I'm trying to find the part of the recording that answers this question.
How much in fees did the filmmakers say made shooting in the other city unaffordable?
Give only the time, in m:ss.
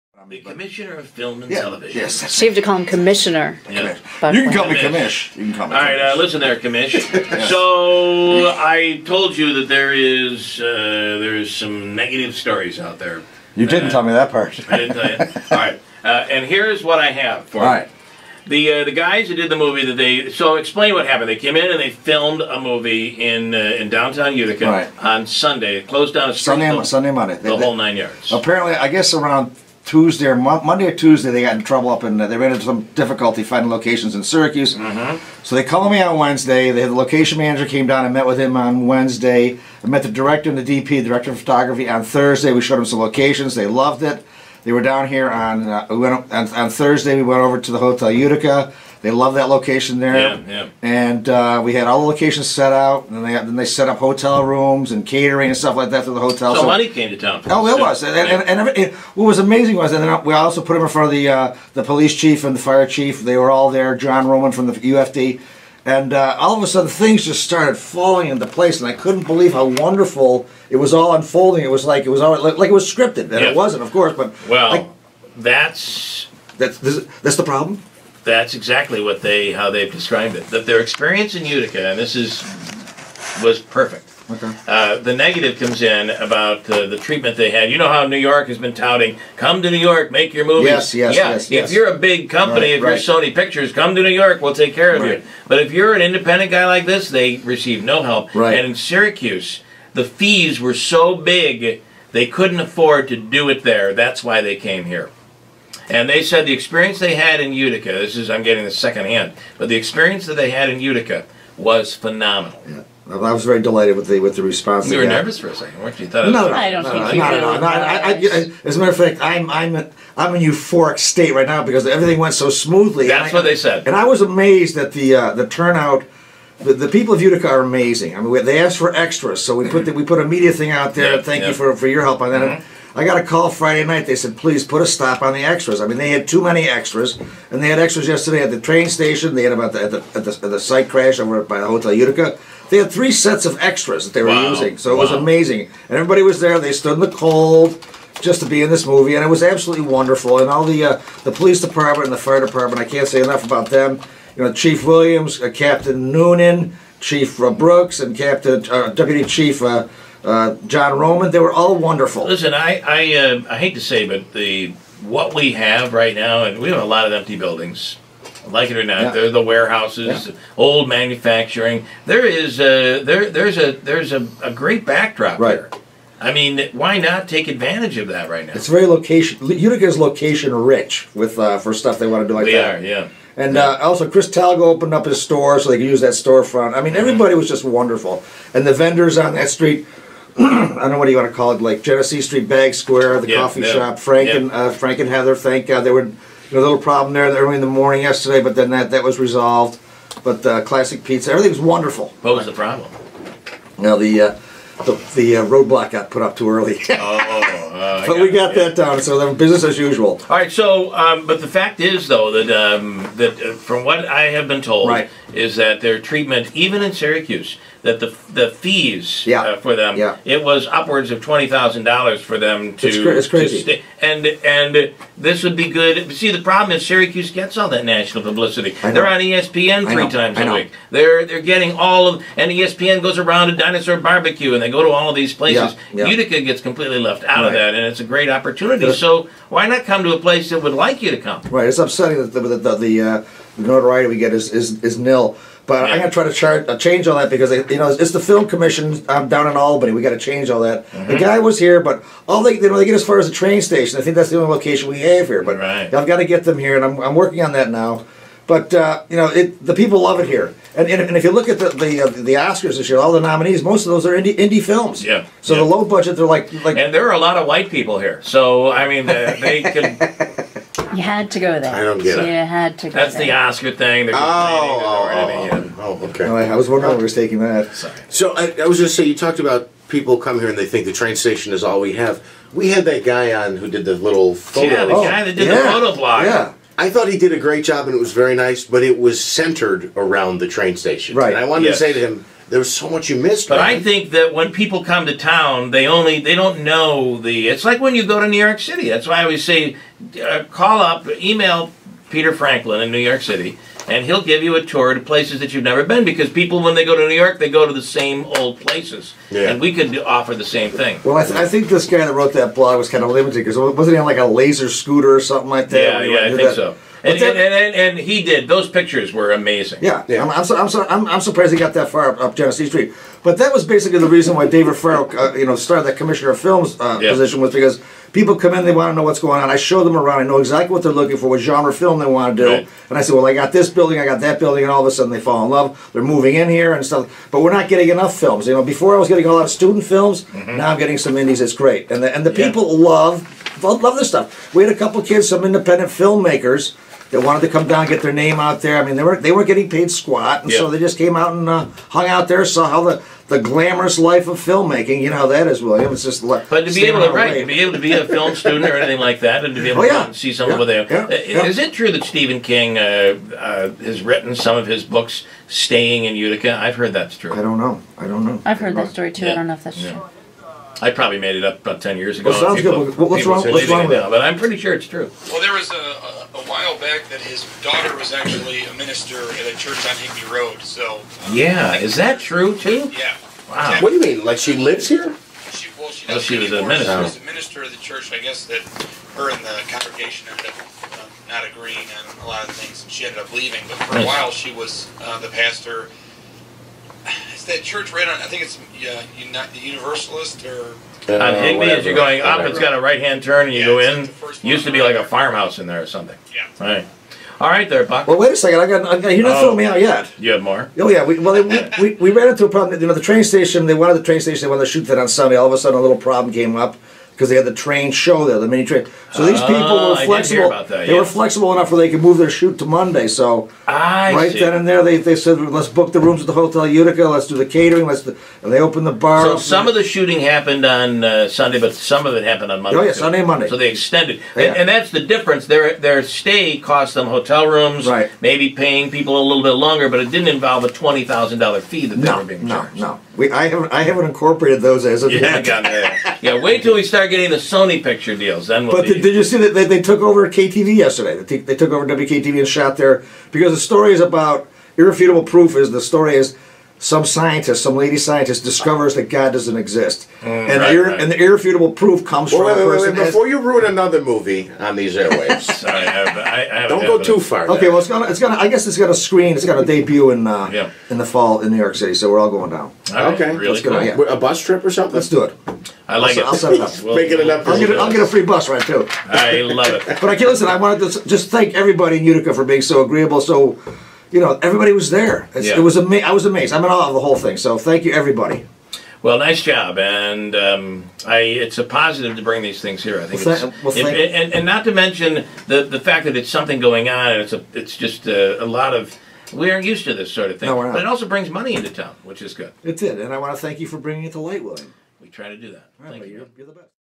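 3:41.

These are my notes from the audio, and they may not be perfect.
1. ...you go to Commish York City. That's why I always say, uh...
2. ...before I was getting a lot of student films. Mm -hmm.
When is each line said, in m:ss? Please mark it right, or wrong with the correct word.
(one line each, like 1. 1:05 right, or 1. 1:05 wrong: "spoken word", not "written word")
1. 4:57 wrong: "New", not "Commish"
2. 5:38 right.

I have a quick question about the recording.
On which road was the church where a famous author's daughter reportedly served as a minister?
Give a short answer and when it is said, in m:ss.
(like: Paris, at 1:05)
Higby Road, at 6:19.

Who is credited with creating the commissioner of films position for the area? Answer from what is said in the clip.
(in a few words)
David Farrell.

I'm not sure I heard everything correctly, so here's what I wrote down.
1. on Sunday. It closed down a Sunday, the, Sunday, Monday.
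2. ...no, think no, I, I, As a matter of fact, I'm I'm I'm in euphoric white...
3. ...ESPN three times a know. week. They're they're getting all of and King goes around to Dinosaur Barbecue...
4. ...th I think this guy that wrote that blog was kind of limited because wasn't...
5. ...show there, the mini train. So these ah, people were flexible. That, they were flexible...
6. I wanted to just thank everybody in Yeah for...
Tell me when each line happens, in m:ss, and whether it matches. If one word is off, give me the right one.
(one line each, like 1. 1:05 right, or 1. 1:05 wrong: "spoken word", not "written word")
1. 0:25 right
2. 1:56 wrong: "state", not "white"
3. 3:49 wrong: "ESPN", not "King"
4. 5:11 right
5. 6:57 right
6. 8:00 wrong: "Utica", not "Yeah".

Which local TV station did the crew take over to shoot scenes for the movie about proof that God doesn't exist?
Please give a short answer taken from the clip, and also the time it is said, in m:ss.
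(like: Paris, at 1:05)
WKTV, at 7:31.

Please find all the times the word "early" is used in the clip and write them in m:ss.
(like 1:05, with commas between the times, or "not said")
3:17, 3:26.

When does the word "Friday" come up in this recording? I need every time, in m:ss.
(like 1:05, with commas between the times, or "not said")
2:13.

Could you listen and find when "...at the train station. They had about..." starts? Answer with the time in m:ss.
2:18.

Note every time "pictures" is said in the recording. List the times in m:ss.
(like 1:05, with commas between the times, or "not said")
1:33, 5:18, 7:27.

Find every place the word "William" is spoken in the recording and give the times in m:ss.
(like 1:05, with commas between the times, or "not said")
2:34, 5:55, 8:24.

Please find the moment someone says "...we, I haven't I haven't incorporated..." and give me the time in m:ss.
7:23.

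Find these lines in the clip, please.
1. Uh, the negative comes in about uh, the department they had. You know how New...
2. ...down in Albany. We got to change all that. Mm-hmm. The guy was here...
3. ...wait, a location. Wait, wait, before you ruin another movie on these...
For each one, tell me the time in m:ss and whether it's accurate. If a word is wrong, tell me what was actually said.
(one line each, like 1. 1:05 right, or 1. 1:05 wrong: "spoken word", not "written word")
1. 1:24 wrong: "treatment", not "department"
2. 4:09 right
3. 7:42 wrong: "person", not "location".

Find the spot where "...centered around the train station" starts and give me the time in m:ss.
4:49.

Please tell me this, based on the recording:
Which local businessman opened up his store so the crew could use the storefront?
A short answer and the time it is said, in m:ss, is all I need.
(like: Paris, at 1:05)
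Chris Talgo, at 3:04.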